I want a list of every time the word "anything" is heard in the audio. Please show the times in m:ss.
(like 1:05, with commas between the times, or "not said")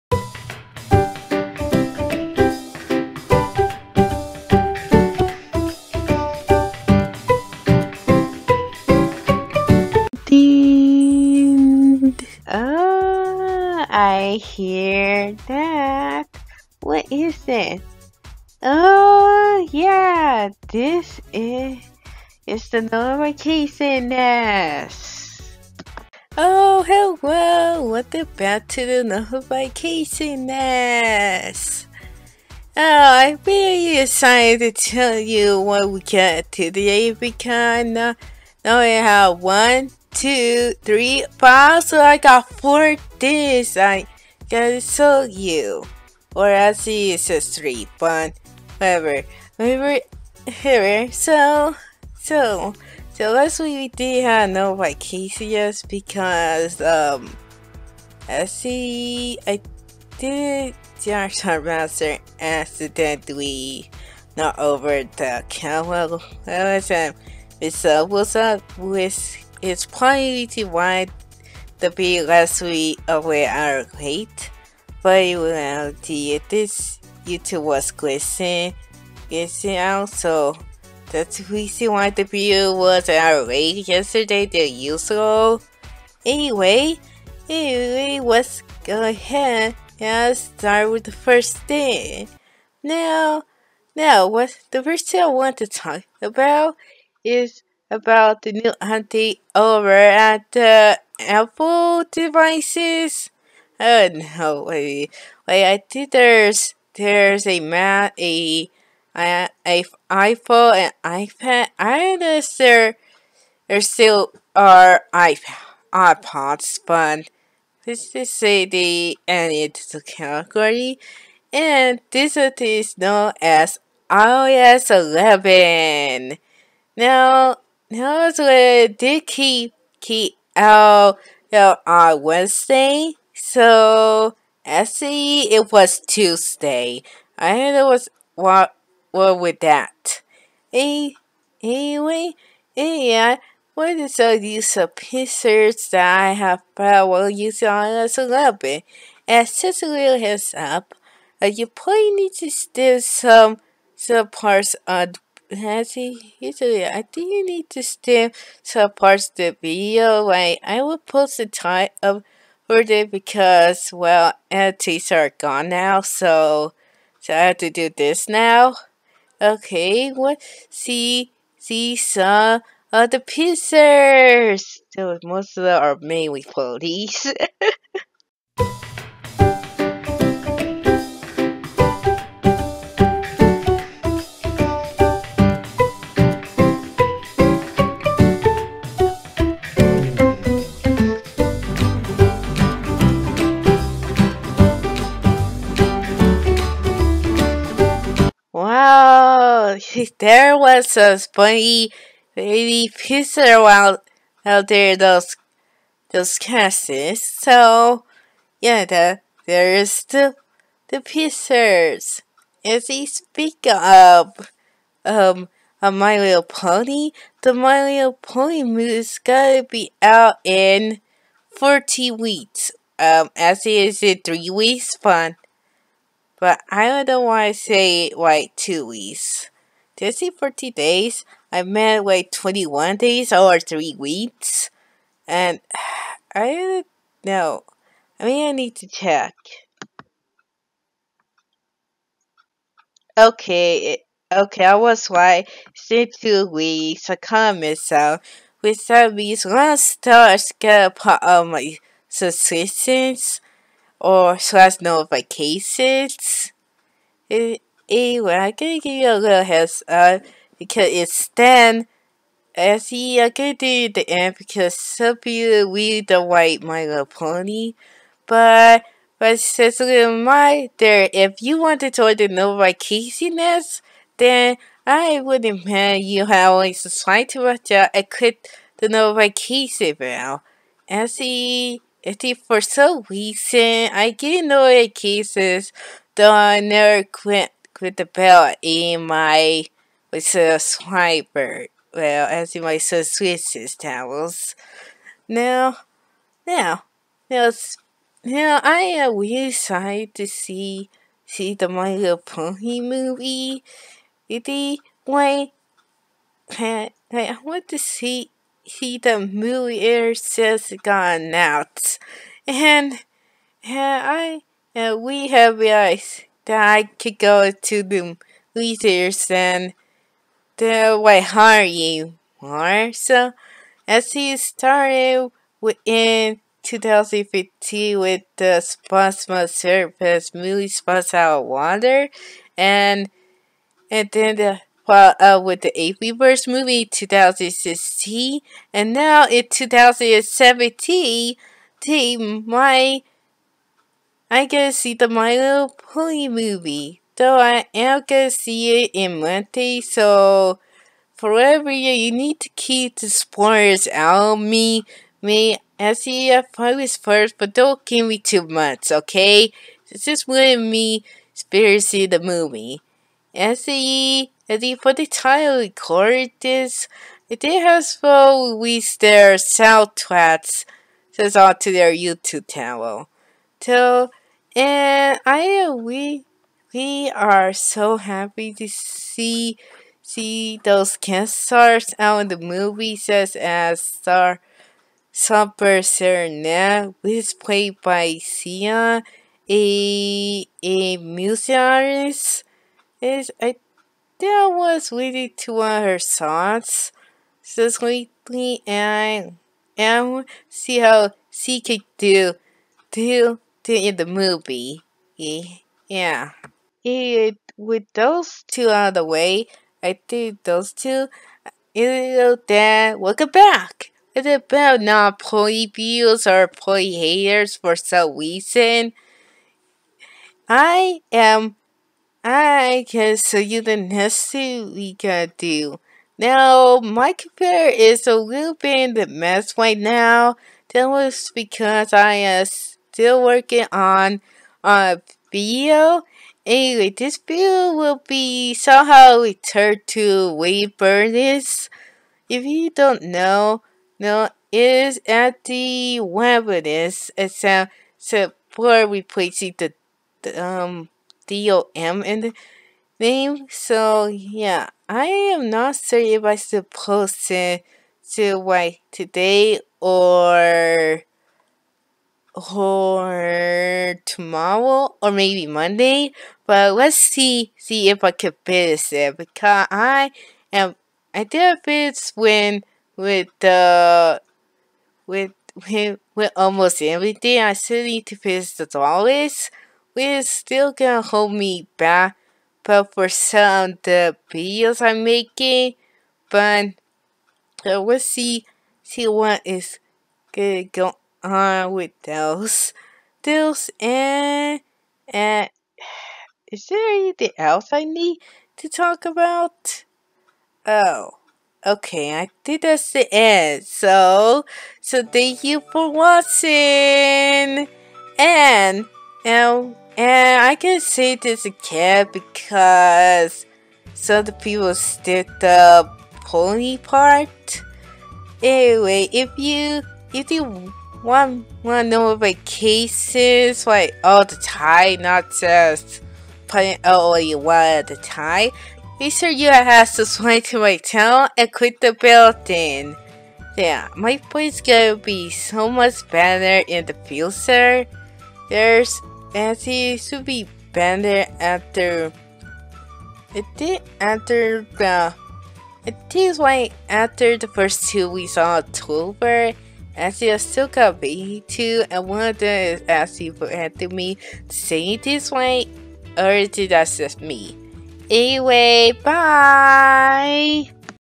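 8:16.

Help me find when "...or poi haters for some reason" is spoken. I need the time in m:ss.
6:56.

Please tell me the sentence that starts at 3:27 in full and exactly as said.
So yeah, the, there's the the pizzas.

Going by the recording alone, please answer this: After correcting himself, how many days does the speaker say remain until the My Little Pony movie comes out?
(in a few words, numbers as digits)
21.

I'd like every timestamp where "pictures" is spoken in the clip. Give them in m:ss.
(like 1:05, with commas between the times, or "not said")
2:24, 2:53.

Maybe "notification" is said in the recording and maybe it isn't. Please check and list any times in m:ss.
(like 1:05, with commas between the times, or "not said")
0:22, 0:29, 4:14.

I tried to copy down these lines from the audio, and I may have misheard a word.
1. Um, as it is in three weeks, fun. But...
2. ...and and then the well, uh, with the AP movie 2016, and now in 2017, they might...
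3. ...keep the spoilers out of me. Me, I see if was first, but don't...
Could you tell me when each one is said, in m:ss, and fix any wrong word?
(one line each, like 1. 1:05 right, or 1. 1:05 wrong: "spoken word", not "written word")
1. 3:42 right
2. 5:32 right
3. 5:52 right.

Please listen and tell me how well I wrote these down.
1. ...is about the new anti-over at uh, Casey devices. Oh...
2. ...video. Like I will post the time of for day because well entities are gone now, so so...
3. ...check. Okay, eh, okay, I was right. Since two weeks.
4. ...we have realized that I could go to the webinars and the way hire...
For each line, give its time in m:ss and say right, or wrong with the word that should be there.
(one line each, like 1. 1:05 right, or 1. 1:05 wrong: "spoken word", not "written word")
1. 1:37 wrong: "Apple", not "Casey"
2. 2:39 right
3. 3:58 right
4. 5:15 wrong: "leaders", not "webinars".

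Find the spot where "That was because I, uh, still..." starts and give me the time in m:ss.
7:10.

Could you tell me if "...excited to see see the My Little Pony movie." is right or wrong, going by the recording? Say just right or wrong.
right.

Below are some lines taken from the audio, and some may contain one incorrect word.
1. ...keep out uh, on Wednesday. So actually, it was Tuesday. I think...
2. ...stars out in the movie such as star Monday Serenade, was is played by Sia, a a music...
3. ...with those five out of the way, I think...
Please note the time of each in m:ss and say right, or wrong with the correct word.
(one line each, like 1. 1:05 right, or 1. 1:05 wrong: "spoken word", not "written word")
1. 2:09 right
2. 6:21 wrong: "Super", not "Monday"
3. 6:47 wrong: "two", not "five".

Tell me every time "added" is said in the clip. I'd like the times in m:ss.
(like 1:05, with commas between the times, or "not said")
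1:59.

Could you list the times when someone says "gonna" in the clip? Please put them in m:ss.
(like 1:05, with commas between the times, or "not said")
3:39, 4:18, 4:23, 5:48, 8:00, 8:10, 8:54.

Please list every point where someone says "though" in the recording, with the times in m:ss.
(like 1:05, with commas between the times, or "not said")
4:46, 5:47.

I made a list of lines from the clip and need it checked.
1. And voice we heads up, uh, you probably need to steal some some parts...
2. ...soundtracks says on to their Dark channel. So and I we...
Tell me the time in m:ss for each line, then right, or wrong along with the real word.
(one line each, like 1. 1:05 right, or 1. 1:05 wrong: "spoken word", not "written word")
1. 2:29 wrong: "since", not "voice"
2. 6:09 wrong: "YouTube", not "Dark".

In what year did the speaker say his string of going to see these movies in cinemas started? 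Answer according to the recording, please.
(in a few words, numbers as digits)
2015.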